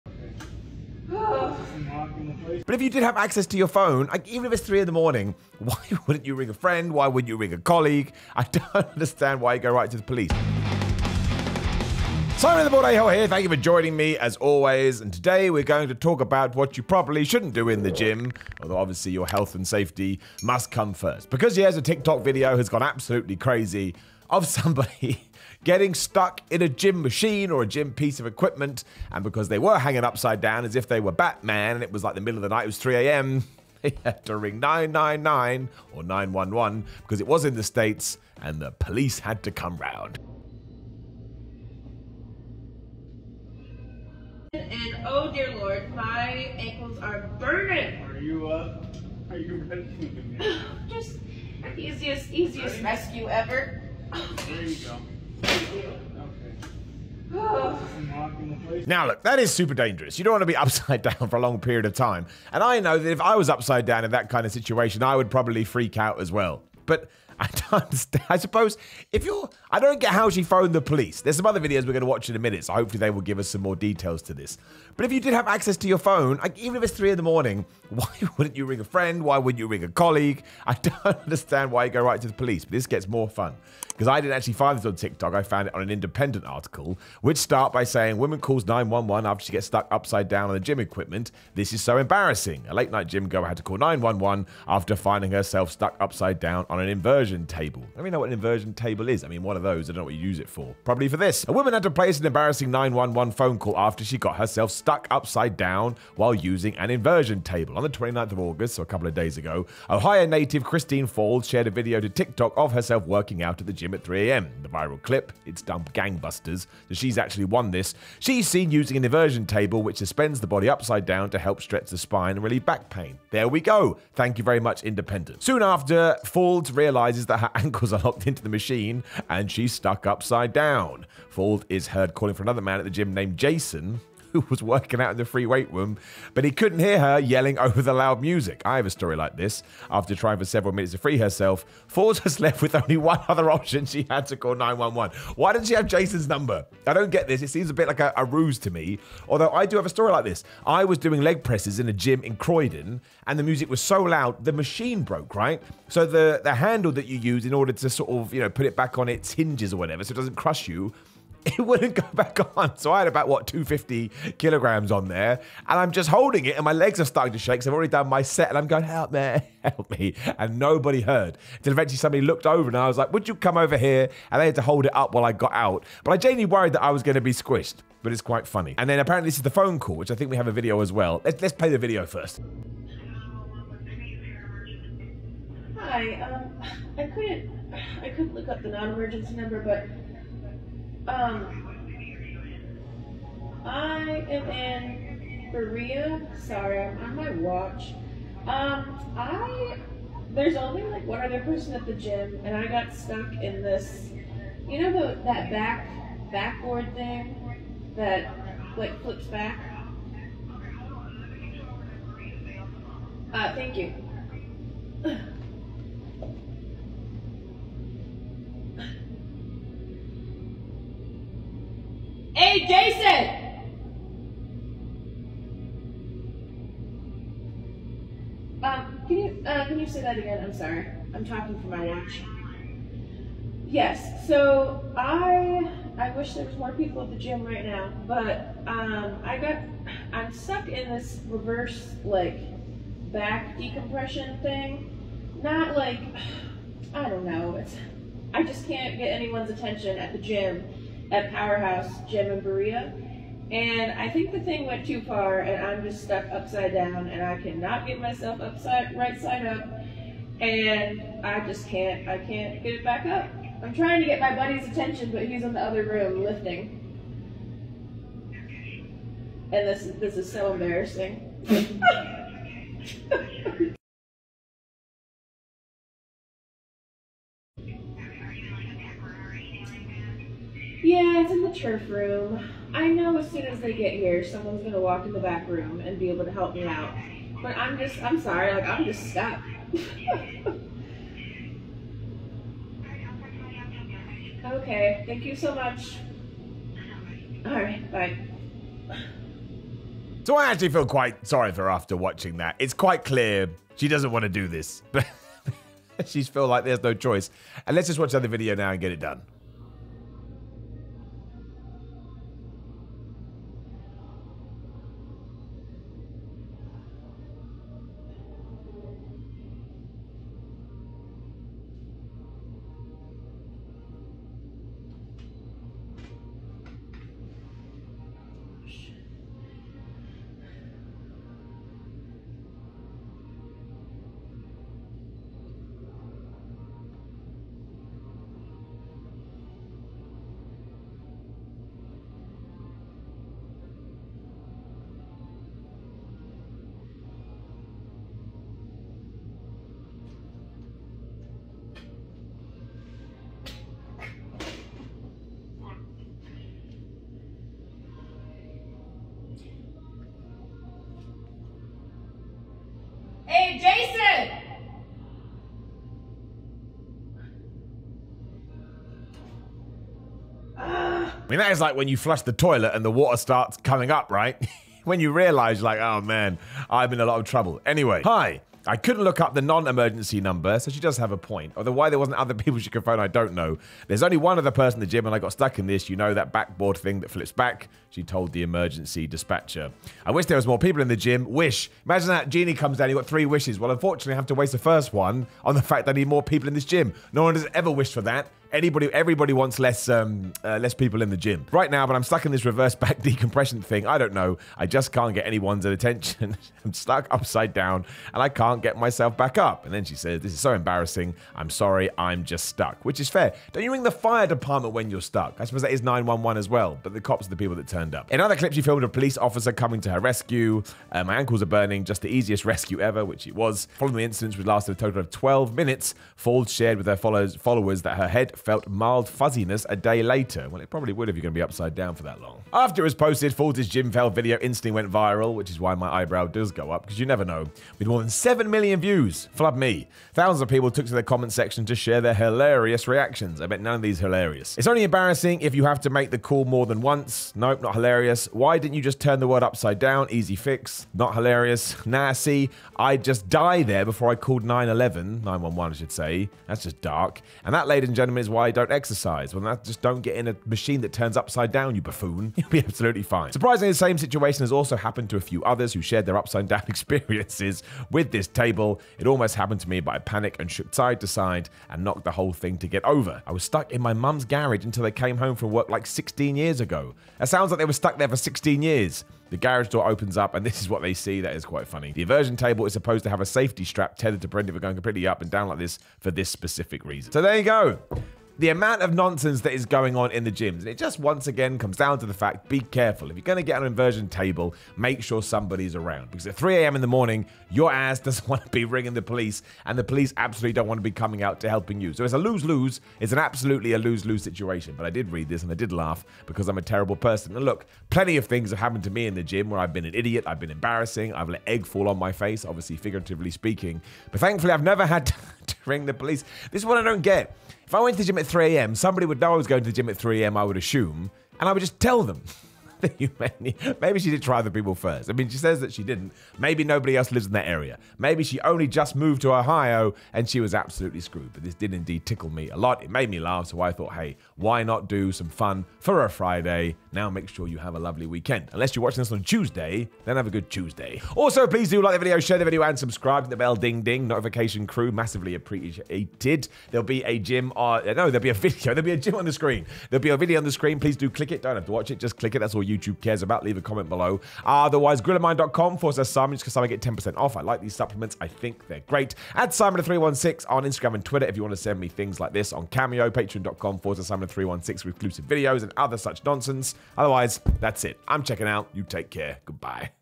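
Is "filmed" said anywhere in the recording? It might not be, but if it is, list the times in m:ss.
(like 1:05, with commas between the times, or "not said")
6:58.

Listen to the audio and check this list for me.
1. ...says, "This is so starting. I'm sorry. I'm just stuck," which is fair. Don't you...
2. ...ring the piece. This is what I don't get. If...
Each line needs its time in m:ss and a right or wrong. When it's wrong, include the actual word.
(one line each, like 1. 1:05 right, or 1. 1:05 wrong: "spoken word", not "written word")
1. 6:49 wrong: "embarrassing", not "starting"
2. 8:35 wrong: "police", not "piece".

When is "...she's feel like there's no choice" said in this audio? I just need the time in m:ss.
5:06.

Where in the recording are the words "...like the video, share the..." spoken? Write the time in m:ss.
9:01.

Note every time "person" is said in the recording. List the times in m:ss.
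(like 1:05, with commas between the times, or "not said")
3:21, 6:24, 8:26.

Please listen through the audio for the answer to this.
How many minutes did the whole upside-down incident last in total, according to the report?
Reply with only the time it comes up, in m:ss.
7:05.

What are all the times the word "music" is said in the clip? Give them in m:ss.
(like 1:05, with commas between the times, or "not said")
2:18, 2:33.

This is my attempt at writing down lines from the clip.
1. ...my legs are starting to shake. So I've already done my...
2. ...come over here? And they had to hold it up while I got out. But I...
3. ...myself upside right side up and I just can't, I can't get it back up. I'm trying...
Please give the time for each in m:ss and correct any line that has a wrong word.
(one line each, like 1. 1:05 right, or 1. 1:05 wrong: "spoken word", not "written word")
1. 2:46 right
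2. 2:53 right
3. 4:17 right.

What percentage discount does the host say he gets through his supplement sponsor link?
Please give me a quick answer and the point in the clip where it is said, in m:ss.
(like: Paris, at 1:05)
10%, at 9:16.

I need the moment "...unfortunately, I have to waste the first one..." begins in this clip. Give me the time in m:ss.
6:33.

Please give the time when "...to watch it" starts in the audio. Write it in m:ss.
9:11.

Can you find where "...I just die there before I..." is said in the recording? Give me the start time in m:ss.
7:32.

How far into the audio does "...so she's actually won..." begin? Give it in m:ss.
1:56.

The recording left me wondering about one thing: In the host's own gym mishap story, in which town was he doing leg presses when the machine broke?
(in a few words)
Croydon.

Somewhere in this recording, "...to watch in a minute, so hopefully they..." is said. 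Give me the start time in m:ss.
1:12.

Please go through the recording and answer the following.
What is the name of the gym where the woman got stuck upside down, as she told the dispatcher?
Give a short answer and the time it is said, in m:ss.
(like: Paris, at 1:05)
Powerhouse Gym, at 4:11.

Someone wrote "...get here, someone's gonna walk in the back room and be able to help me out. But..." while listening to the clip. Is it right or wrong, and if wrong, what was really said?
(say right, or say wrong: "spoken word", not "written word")
right.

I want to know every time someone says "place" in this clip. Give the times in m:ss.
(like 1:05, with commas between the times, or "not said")
1:41.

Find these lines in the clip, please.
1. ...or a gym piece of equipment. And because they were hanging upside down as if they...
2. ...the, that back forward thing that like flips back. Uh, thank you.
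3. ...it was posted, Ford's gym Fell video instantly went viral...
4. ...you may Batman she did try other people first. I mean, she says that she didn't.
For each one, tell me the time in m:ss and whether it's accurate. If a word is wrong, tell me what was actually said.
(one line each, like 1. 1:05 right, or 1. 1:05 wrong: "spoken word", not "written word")
1. 0:27 right
2. 3:24 wrong: "backboard", not "forward"
3. 7:12 right
4. 8:42 wrong: "Maybe", not "Batman".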